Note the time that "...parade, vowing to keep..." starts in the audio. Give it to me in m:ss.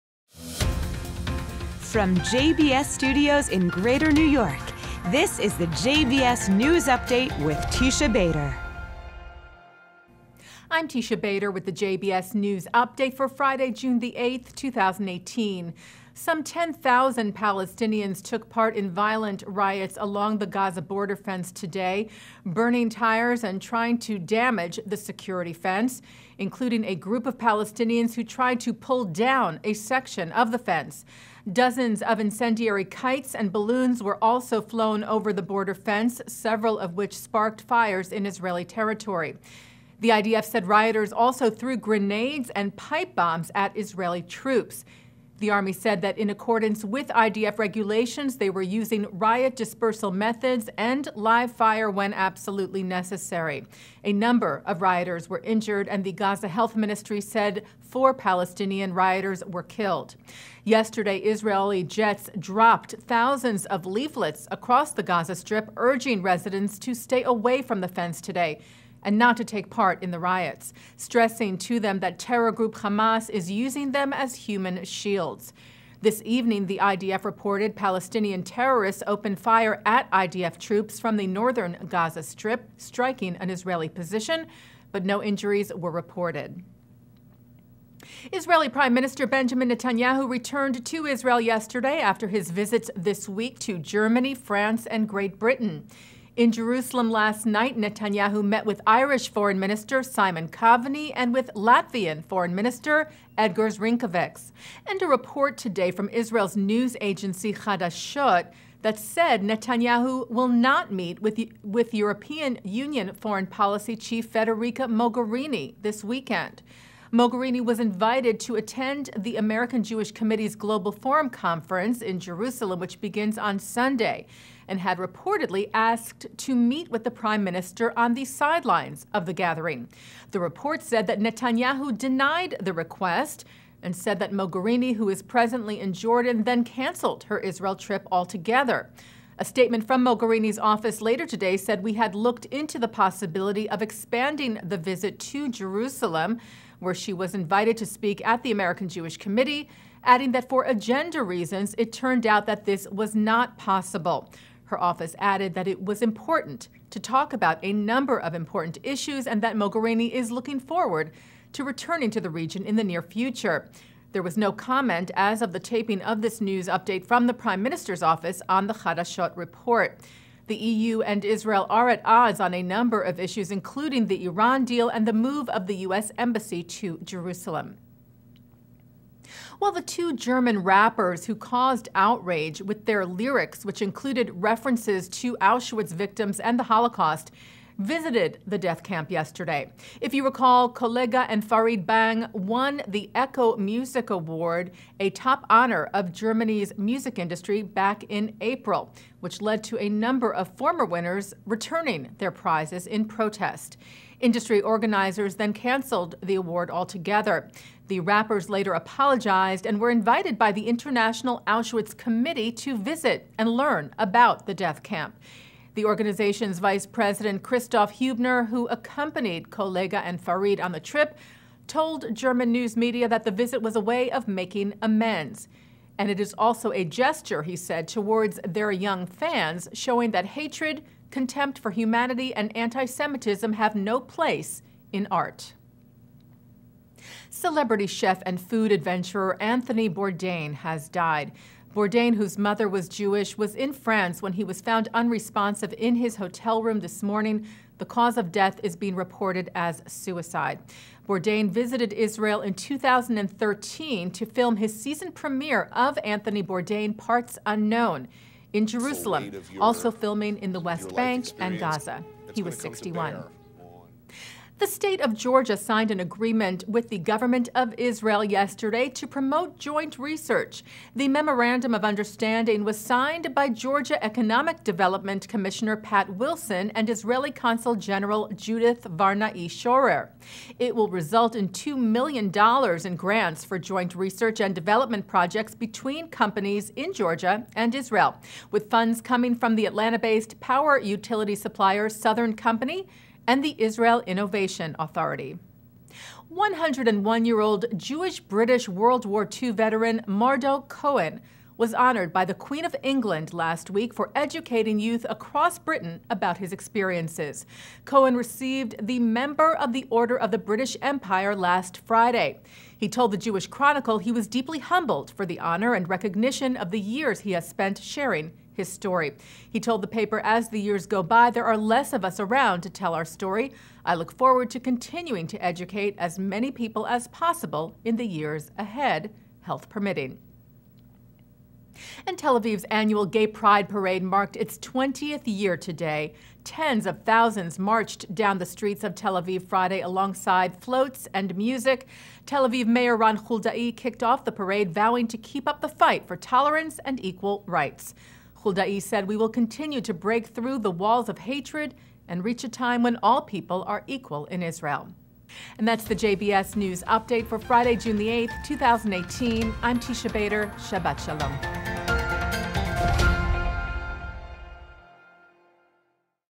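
5:44.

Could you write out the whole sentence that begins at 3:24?
Industry organizers then canceled the award altogether.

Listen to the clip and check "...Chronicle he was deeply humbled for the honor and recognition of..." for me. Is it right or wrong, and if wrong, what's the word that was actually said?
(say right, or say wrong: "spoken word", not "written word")
right.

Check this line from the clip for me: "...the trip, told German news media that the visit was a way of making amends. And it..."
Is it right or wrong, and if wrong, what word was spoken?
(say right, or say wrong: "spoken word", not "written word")
right.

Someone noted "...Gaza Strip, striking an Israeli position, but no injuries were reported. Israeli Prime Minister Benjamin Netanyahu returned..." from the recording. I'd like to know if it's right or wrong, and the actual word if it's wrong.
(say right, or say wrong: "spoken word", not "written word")
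right.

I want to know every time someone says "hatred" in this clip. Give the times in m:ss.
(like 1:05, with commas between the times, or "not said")
3:50, 5:51.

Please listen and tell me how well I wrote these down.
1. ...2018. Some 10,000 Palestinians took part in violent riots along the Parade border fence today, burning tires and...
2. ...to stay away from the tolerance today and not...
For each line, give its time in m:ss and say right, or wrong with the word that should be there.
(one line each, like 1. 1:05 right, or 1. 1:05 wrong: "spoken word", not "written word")
1. 0:14 wrong: "Gaza", not "Parade"
2. 1:06 wrong: "fence", not "tolerance".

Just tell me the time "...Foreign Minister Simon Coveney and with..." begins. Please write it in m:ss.
1:39.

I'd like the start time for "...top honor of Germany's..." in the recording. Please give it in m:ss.
3:15.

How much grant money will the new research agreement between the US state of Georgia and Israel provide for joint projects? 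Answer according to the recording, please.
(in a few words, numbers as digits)
$2 million.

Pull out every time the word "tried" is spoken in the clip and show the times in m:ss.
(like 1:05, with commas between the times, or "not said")
0:28.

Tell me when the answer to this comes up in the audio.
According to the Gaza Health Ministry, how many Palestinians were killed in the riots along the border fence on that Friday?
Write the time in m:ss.
0:57.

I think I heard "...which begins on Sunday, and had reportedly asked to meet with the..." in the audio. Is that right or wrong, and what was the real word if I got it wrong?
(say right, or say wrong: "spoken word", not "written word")
right.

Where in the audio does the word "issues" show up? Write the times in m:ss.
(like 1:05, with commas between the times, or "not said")
2:38, 2:53.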